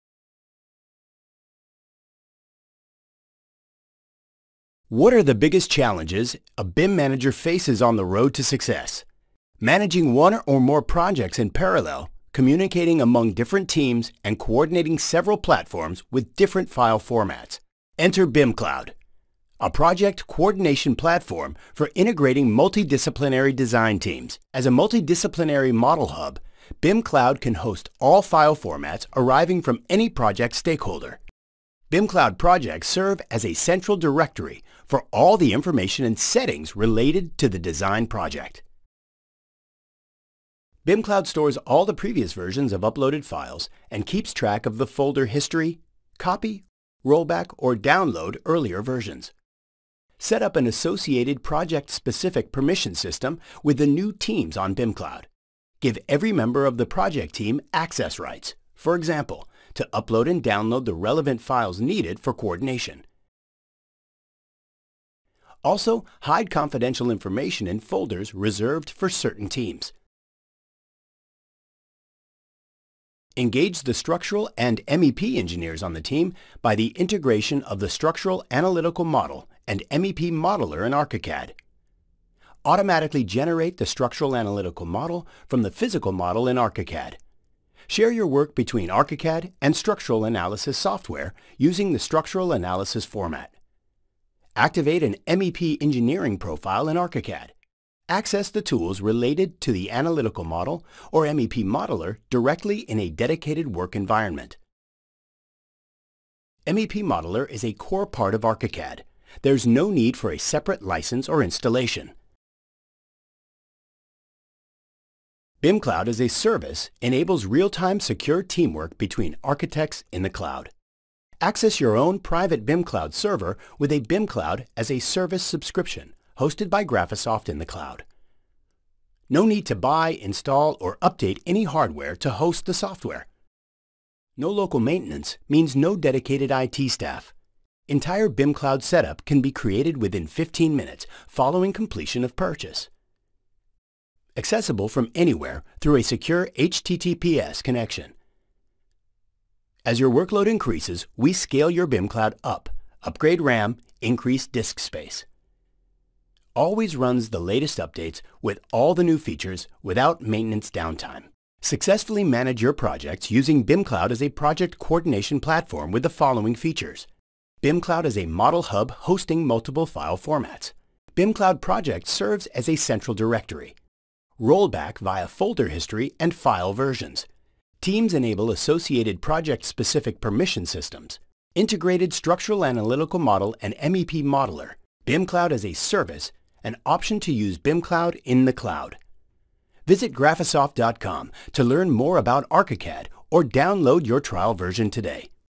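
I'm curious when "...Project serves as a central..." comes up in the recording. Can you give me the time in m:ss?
2:51.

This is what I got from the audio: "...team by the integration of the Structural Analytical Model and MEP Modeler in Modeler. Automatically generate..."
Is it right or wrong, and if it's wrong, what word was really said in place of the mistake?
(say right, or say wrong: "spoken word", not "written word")
wrong: "ArchiCAD", not "Modeler".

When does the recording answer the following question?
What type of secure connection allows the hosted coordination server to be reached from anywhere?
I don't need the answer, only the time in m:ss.
2:26.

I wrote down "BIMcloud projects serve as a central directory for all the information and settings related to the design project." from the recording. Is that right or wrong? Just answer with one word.
right.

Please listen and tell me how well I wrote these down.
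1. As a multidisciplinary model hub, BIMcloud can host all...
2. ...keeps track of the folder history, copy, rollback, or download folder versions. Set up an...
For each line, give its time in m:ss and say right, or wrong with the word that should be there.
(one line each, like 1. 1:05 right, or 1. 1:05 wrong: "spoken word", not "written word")
1. 0:24 right
2. 0:44 wrong: "earlier", not "folder".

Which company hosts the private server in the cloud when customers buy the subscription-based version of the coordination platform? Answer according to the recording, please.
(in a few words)
Graphisoft.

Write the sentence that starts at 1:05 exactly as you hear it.
Also, hide confidential information in folders reserved for certain teams.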